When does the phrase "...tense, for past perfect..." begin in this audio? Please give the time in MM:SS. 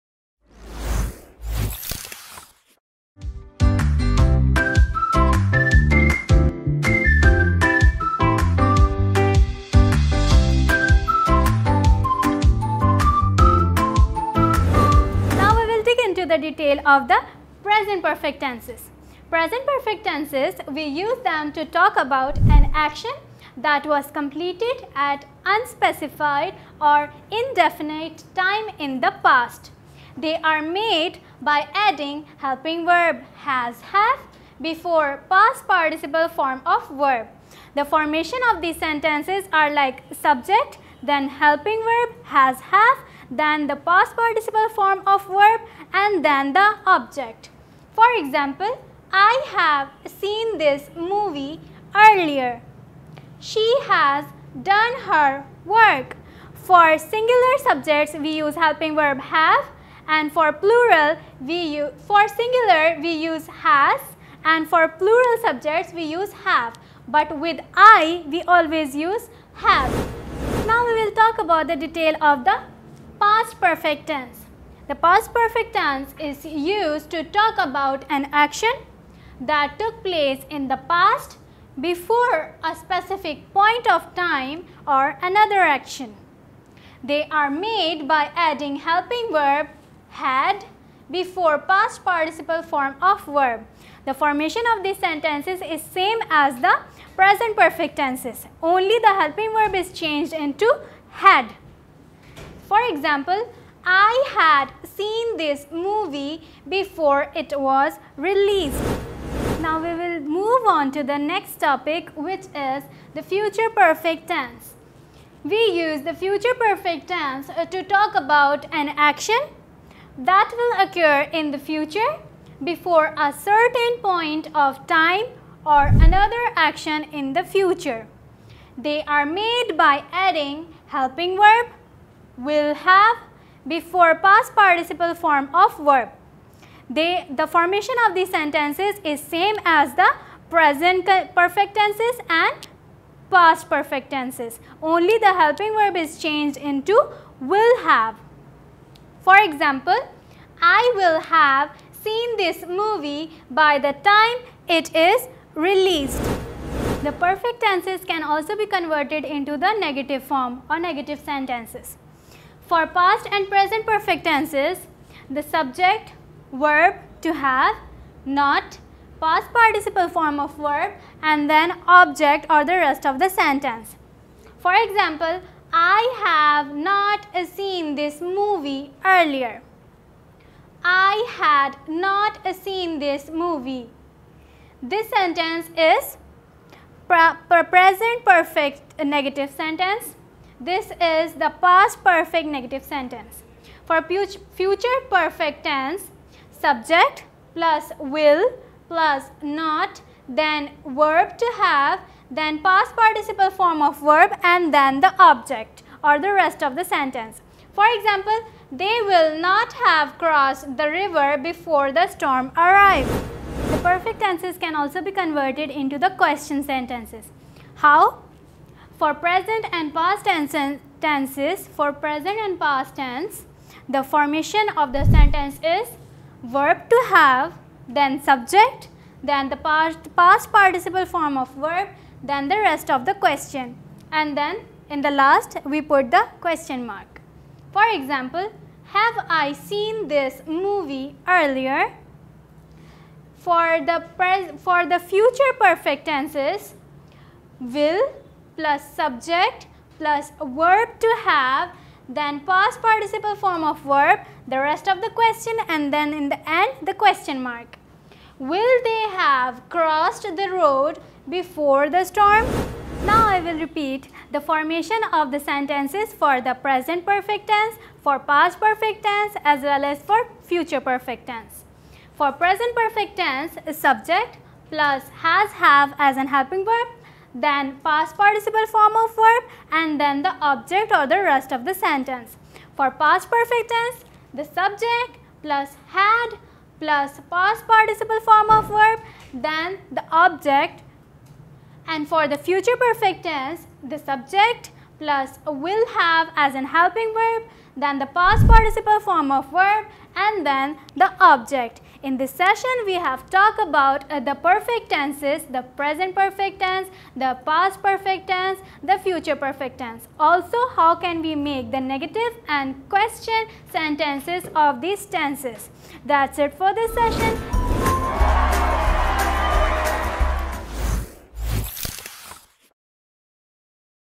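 04:27.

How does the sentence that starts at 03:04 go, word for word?
This sentence is pre present perfect negative sentence this is the past perfect negative sentence.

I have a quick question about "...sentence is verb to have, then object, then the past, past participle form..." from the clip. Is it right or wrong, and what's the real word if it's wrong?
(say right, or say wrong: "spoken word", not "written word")
wrong: "subject", not "object".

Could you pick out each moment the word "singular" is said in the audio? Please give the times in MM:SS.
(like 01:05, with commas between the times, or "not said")
00:56, 01:02.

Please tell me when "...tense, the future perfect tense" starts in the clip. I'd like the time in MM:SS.
05:08.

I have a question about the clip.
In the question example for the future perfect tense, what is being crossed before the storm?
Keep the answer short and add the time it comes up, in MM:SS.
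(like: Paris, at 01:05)
the road, at 04:19.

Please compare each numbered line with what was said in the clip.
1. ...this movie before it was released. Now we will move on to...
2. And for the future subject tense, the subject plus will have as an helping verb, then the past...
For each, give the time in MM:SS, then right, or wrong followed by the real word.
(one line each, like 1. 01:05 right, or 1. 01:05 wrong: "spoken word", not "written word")
1. 01:45 right
2. 04:51 wrong: "perfect", not "subject".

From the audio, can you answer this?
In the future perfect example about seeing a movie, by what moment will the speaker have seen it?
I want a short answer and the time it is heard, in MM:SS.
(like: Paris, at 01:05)
by the time it is released, at 02:33.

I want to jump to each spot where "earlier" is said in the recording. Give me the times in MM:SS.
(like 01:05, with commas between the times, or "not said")
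00:51, 02:59, 04:01.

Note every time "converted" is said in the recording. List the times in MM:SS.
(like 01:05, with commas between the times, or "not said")
02:38, 03:35.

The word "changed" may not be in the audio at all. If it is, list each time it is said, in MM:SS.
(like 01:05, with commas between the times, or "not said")
01:39, 02:26.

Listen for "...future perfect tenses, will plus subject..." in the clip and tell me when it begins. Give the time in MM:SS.
04:04.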